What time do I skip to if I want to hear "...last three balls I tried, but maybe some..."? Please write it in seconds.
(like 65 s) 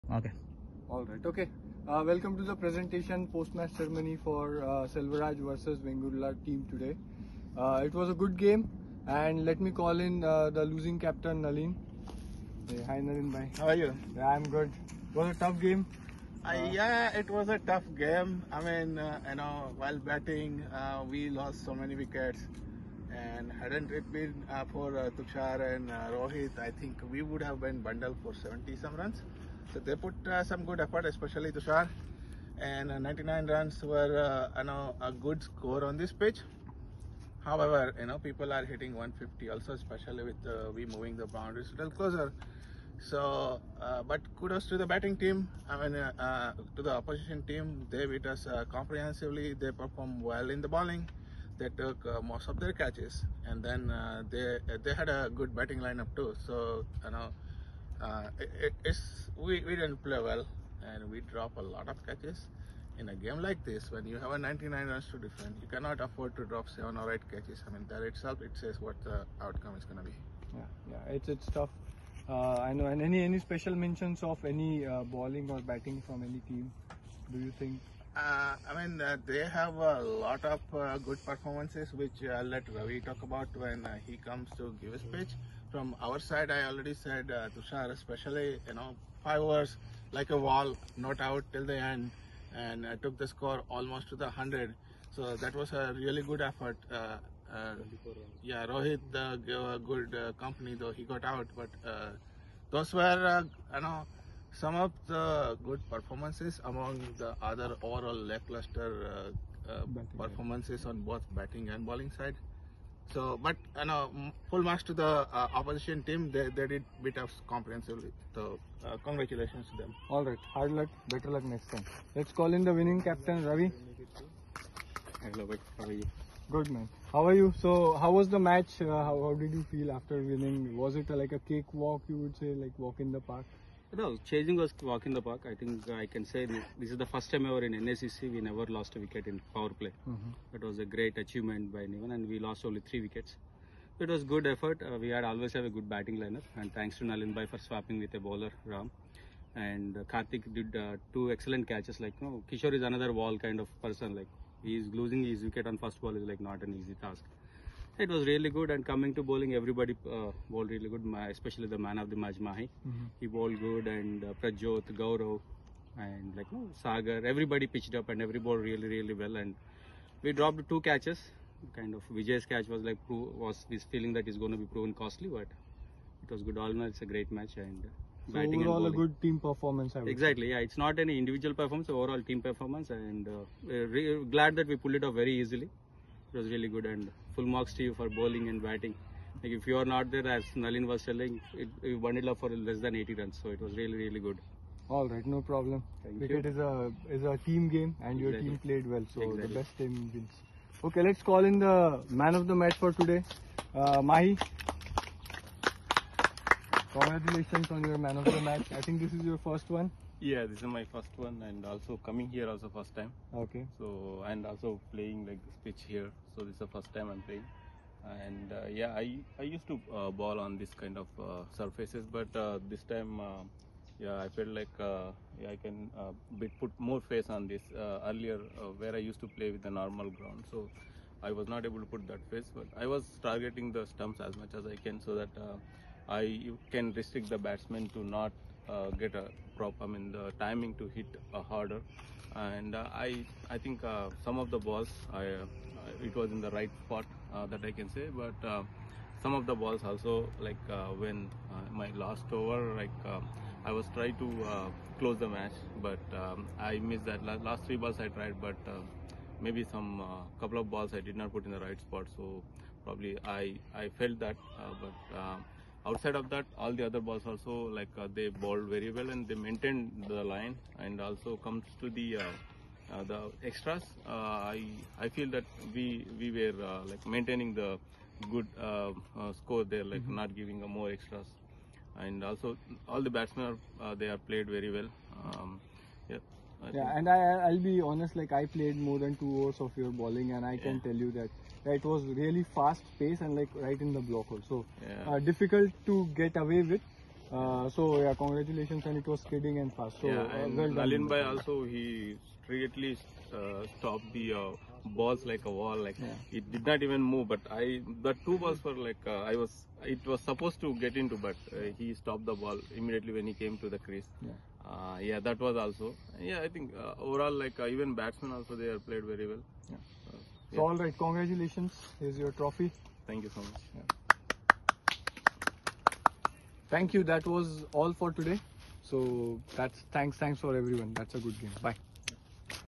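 257 s.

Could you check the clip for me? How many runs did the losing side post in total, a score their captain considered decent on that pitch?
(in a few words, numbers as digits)
99.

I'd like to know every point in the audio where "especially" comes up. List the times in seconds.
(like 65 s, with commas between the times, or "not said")
31 s, 39 s, 87 s, 161 s.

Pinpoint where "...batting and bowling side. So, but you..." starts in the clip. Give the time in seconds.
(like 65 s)
111 s.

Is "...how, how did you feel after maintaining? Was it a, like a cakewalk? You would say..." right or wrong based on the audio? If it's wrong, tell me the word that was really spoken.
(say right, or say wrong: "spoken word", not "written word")
wrong: "winning", not "maintaining".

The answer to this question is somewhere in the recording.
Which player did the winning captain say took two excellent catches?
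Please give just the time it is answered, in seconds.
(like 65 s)
150 s.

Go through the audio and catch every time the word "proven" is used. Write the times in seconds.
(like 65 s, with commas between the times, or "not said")
174 s.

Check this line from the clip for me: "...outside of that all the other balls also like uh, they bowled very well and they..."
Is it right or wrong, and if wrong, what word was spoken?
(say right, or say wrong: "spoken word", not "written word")
right.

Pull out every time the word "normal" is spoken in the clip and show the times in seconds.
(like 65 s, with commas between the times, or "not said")
229 s.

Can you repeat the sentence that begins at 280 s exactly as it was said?
not giving more extras and also all the batsmen are, they are played very well um, yeah.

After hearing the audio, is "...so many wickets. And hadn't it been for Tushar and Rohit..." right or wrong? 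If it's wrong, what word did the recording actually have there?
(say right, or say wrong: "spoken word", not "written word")
right.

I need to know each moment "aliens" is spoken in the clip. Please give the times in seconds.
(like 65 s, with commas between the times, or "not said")
not said.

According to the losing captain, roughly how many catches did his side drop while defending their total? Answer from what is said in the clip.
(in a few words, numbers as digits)
seven or eight.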